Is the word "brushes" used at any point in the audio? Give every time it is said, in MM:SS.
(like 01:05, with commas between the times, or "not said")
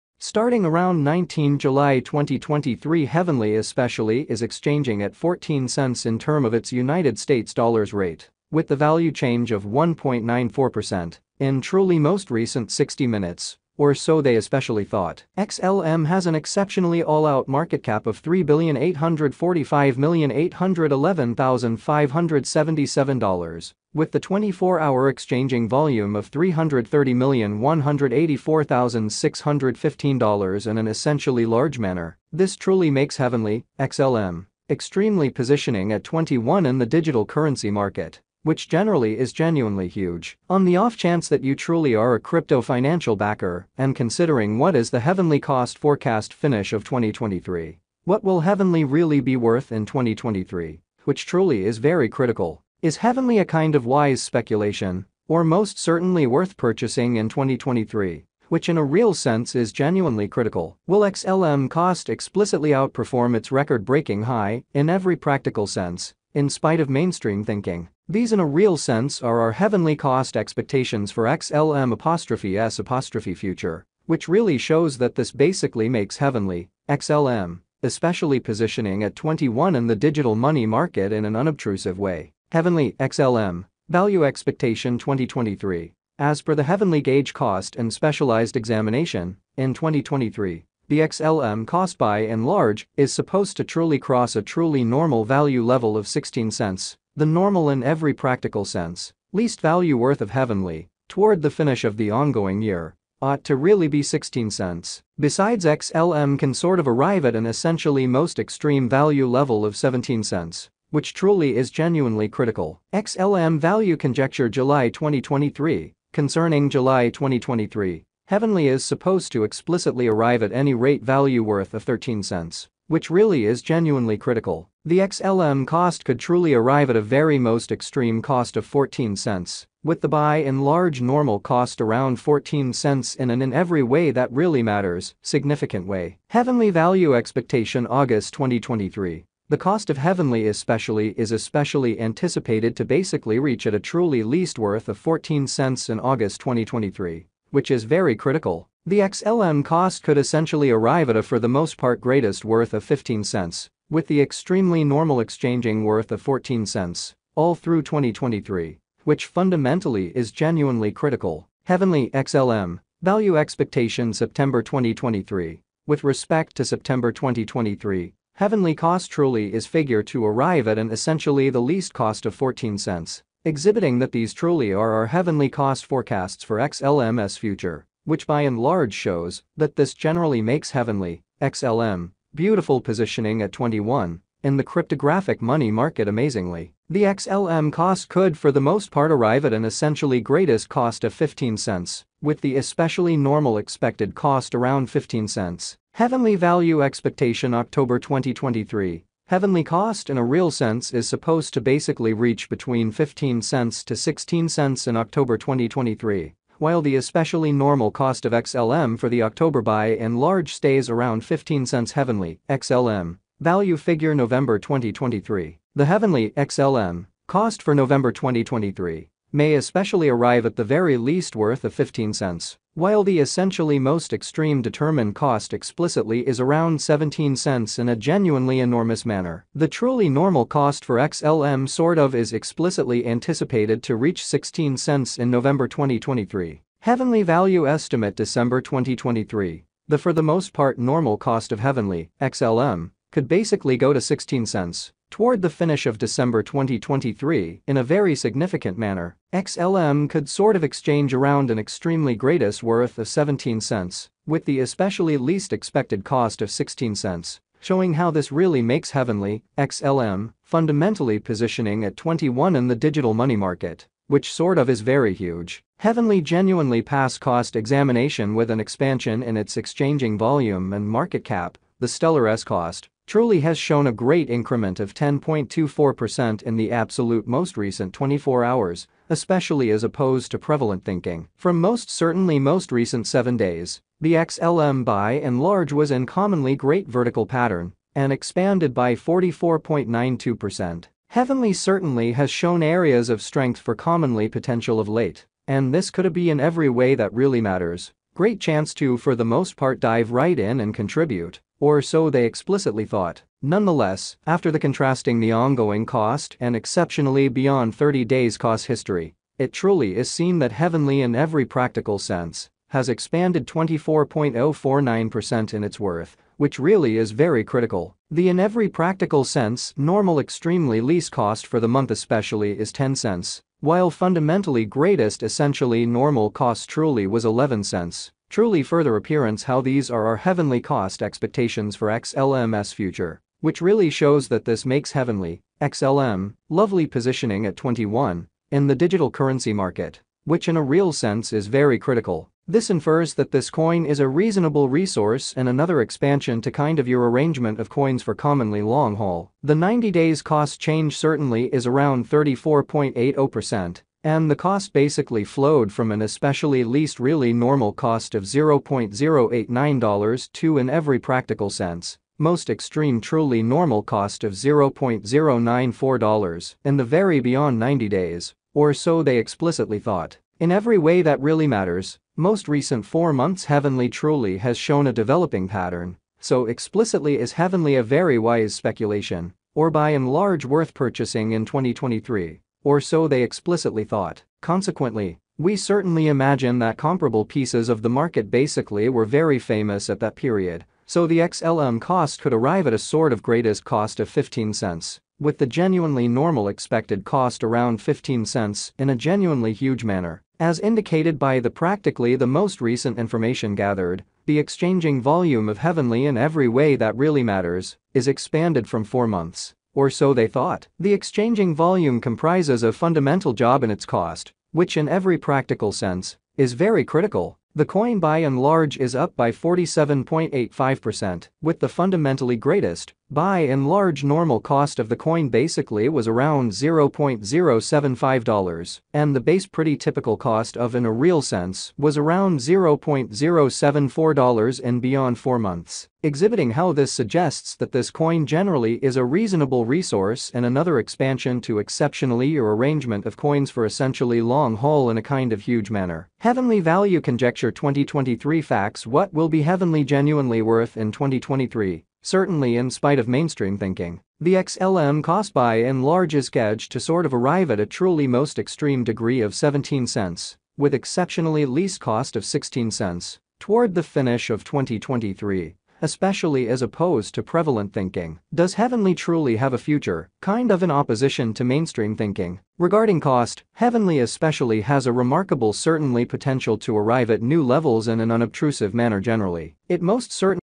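not said.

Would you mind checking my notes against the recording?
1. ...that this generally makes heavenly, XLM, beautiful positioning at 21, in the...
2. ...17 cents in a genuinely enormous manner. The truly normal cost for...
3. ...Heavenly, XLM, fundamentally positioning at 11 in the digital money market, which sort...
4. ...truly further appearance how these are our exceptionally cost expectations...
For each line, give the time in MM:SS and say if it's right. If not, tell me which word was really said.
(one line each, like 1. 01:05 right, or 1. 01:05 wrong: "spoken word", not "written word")
1. 02:59 right
2. 03:46 right
3. 04:18 wrong: "21", not "11"
4. 05:28 wrong: "heavenly", not "exceptionally".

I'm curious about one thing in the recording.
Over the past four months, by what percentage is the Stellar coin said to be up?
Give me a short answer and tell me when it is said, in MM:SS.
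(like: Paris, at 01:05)
47.85%, at 06:59.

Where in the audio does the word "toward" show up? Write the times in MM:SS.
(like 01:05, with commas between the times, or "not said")
01:41, 04:05, 07:43.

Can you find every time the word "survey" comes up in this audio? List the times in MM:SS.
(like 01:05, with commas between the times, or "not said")
not said.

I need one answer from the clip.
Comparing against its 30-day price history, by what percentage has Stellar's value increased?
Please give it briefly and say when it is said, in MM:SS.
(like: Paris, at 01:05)
24.049%, at 05:13.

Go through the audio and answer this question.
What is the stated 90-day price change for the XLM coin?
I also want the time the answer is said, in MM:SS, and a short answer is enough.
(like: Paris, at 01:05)
34.80%, at 05:52.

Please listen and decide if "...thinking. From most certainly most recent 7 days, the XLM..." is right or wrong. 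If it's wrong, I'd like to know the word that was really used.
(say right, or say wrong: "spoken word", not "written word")
right.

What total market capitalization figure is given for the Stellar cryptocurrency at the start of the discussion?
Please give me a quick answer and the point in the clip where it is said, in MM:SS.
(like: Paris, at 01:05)
$3,845,811,577, at 00:18.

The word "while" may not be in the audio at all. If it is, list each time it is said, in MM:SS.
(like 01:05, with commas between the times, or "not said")
03:26, 03:42, 05:23.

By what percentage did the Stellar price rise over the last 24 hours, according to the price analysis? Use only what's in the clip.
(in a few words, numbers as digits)
10.24%.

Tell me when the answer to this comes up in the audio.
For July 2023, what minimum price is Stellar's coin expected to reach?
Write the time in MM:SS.
02:01.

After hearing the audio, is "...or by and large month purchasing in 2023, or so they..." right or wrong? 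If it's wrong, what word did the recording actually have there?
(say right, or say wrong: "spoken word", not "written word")
wrong: "worth", not "month".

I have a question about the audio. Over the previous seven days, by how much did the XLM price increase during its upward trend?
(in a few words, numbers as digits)
44.92%.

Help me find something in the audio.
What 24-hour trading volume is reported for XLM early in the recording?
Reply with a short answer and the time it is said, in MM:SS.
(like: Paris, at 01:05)
$330,184,615, at 00:26.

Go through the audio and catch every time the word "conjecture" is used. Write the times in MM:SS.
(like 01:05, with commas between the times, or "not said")
01:53, 07:27.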